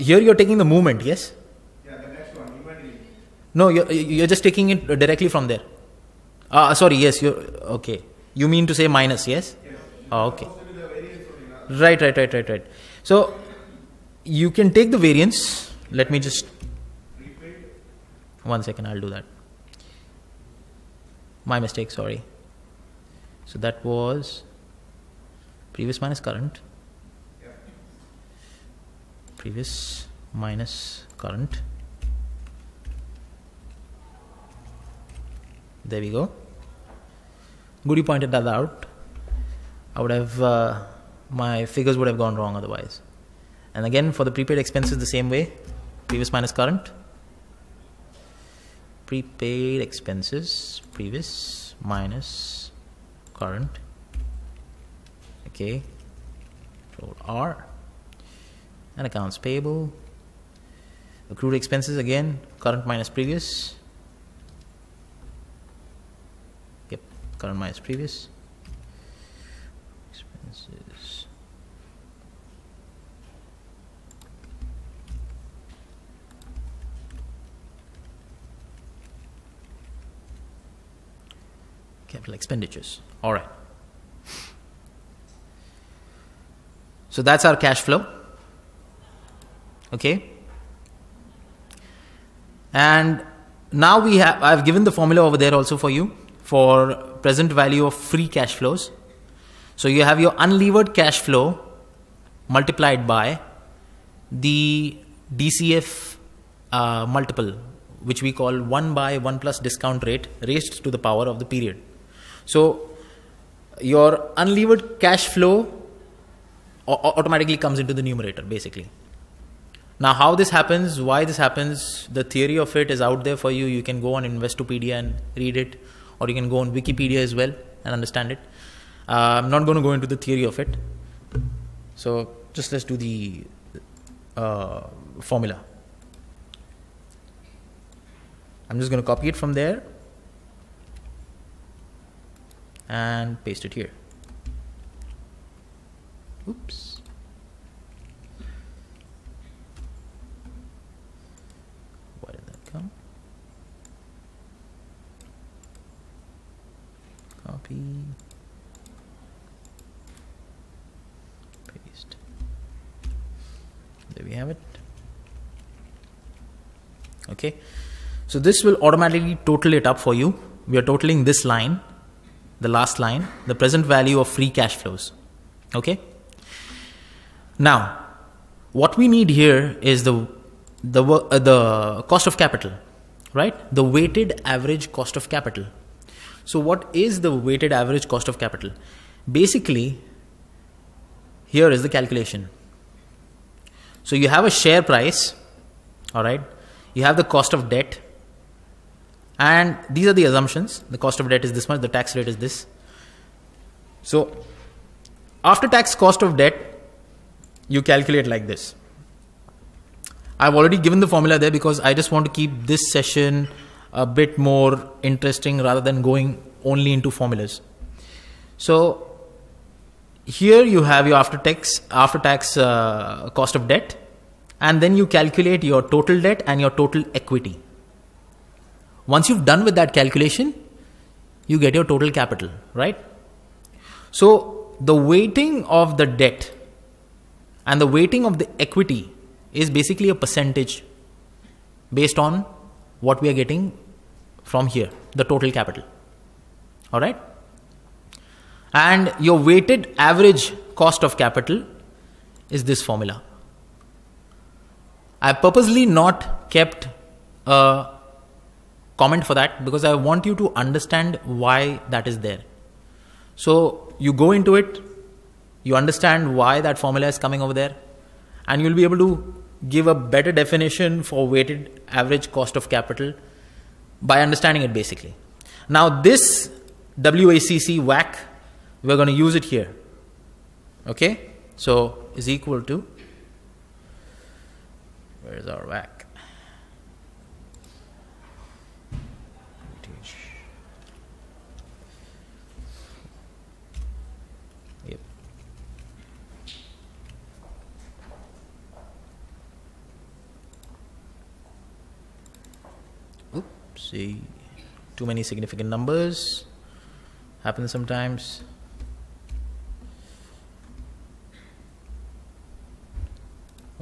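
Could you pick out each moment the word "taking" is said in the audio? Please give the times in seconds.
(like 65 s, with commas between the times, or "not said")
0 s, 4 s.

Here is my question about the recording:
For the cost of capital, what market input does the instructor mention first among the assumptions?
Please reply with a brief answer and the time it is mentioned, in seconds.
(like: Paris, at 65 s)
share price, at 194 s.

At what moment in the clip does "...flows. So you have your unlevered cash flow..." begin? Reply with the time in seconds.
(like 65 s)
98 s.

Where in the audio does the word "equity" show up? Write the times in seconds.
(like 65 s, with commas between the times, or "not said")
227 s, 238 s.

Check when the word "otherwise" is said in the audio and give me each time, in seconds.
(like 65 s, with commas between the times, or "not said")
42 s.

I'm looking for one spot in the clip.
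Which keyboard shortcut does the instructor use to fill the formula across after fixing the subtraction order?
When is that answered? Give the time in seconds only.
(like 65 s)
56 s.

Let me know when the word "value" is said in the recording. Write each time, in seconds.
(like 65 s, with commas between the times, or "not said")
97 s, 173 s.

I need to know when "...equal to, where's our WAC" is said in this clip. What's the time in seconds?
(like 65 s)
282 s.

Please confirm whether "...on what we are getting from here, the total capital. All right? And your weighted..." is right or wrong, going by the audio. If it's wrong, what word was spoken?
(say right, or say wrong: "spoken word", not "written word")
right.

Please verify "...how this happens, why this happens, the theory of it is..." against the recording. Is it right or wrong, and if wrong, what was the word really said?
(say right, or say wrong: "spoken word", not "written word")
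right.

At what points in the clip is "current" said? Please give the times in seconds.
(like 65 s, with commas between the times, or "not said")
26 s, 31 s, 46 s, 53 s, 62 s, 67 s.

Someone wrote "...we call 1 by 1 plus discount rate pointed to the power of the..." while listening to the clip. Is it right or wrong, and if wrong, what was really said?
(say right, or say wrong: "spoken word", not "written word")
wrong: "raised", not "pointed".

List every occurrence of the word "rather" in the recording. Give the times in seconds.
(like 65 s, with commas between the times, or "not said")
215 s.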